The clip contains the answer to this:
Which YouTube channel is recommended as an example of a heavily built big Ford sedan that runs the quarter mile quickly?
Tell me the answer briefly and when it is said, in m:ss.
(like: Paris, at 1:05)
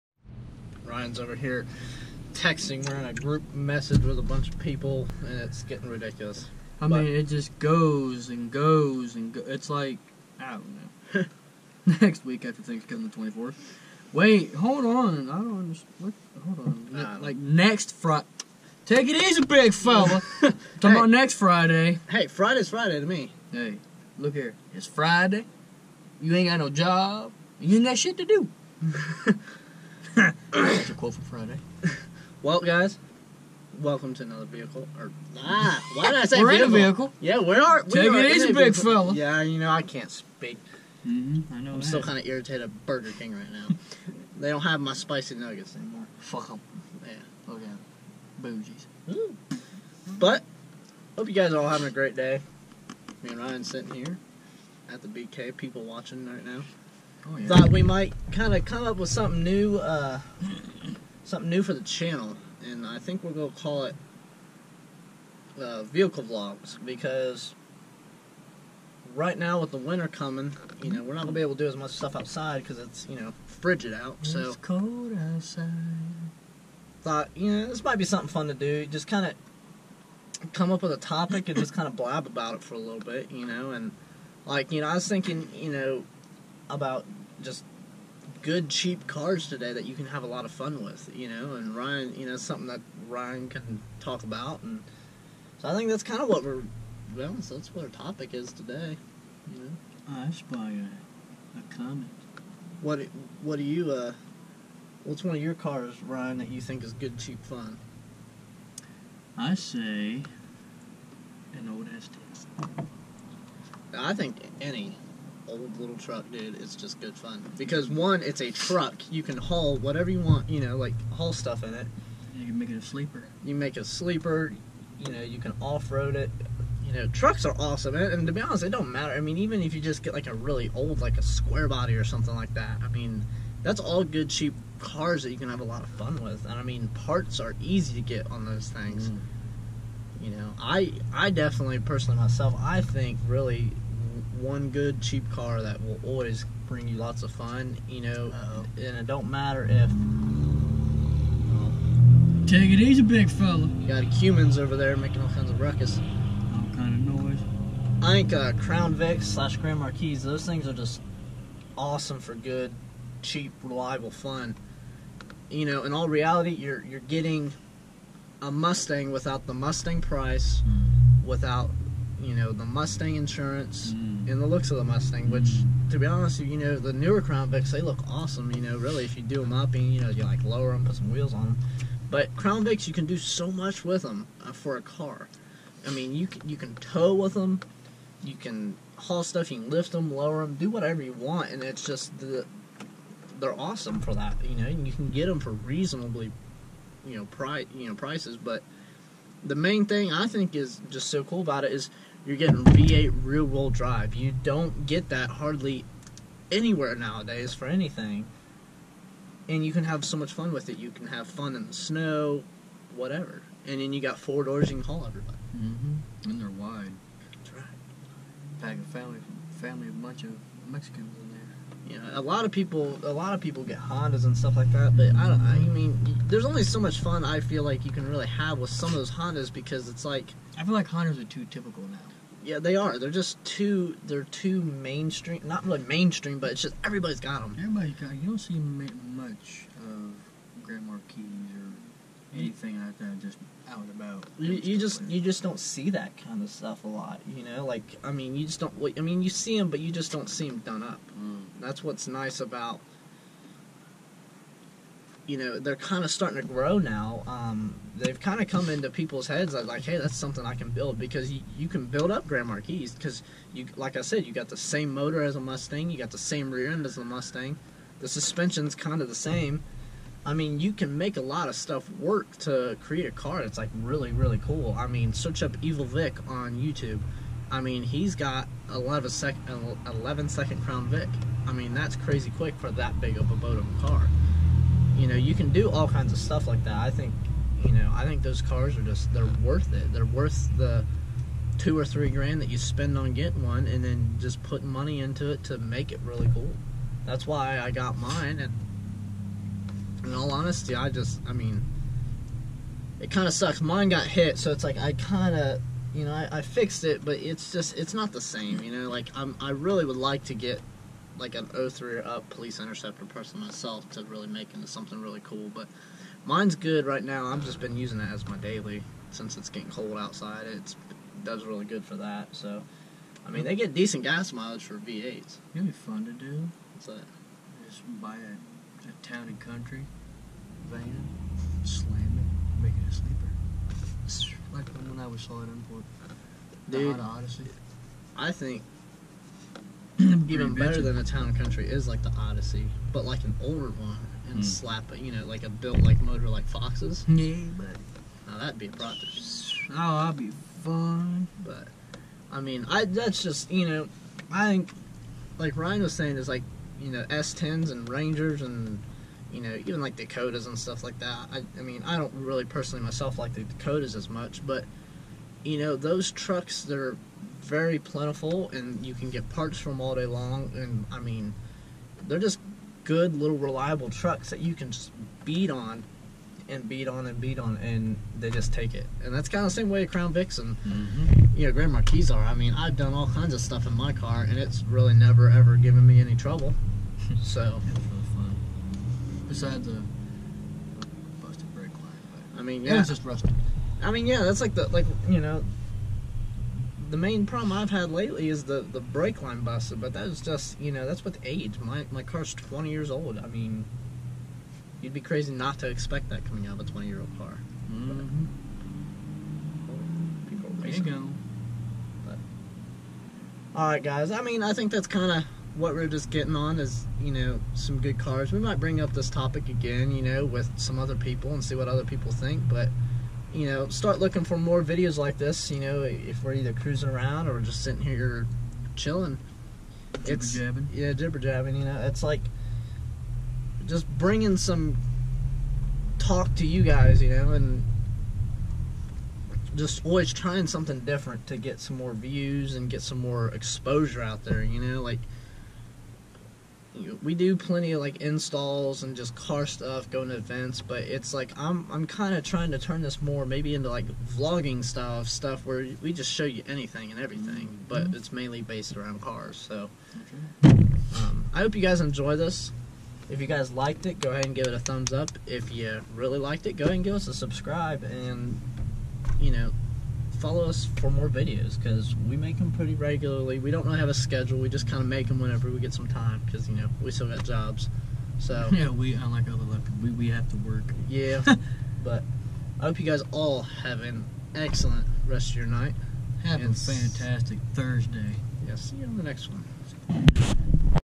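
Evil Vic, at 4:35.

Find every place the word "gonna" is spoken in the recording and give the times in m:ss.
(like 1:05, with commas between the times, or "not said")
1:03, 1:11.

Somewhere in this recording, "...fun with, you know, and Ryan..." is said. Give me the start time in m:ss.
1:30.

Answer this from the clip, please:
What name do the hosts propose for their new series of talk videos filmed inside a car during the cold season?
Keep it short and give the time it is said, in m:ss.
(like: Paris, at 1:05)
vehicle vlogs, at 1:05.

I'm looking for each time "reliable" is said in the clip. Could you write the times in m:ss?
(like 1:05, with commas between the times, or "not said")
2:43, 6:13.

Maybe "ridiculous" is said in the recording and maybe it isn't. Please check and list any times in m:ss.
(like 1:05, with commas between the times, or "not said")
0:05.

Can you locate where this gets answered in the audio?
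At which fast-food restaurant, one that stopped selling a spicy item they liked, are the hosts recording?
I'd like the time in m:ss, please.
0:42.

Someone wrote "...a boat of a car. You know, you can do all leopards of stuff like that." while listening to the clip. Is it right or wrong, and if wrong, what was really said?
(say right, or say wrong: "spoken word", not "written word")
wrong: "kinds", not "leopards".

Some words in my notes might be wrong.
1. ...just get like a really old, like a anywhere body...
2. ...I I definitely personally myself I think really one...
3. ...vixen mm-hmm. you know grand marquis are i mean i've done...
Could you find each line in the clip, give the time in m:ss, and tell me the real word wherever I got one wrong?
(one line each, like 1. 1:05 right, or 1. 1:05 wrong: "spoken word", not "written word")
1. 2:09 wrong: "square", not "anywhere"
2. 2:20 right
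3. 6:20 right.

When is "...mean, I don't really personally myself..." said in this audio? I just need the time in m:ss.
6:01.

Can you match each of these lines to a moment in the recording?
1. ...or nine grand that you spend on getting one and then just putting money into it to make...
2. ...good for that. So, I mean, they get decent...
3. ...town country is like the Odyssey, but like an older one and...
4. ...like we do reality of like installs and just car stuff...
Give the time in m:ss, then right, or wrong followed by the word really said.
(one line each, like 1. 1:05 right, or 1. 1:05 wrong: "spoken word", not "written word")
1. 4:51 wrong: "three", not "nine"
2. 5:21 right
3. 5:41 right
4. 7:24 wrong: "plenty", not "reality".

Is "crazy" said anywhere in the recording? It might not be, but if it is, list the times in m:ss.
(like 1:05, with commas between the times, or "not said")
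4:41, 6:44.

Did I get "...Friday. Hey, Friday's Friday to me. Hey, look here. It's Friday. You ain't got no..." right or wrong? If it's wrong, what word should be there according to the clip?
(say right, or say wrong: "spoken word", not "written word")
right.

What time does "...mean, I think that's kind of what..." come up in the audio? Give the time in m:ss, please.
6:54.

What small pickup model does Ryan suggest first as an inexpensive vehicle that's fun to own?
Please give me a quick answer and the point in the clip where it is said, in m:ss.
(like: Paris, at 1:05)
S10, at 1:51.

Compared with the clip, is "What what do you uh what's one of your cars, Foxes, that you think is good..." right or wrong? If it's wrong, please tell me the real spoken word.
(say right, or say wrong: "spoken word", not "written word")
wrong: "Ryan", not "Foxes".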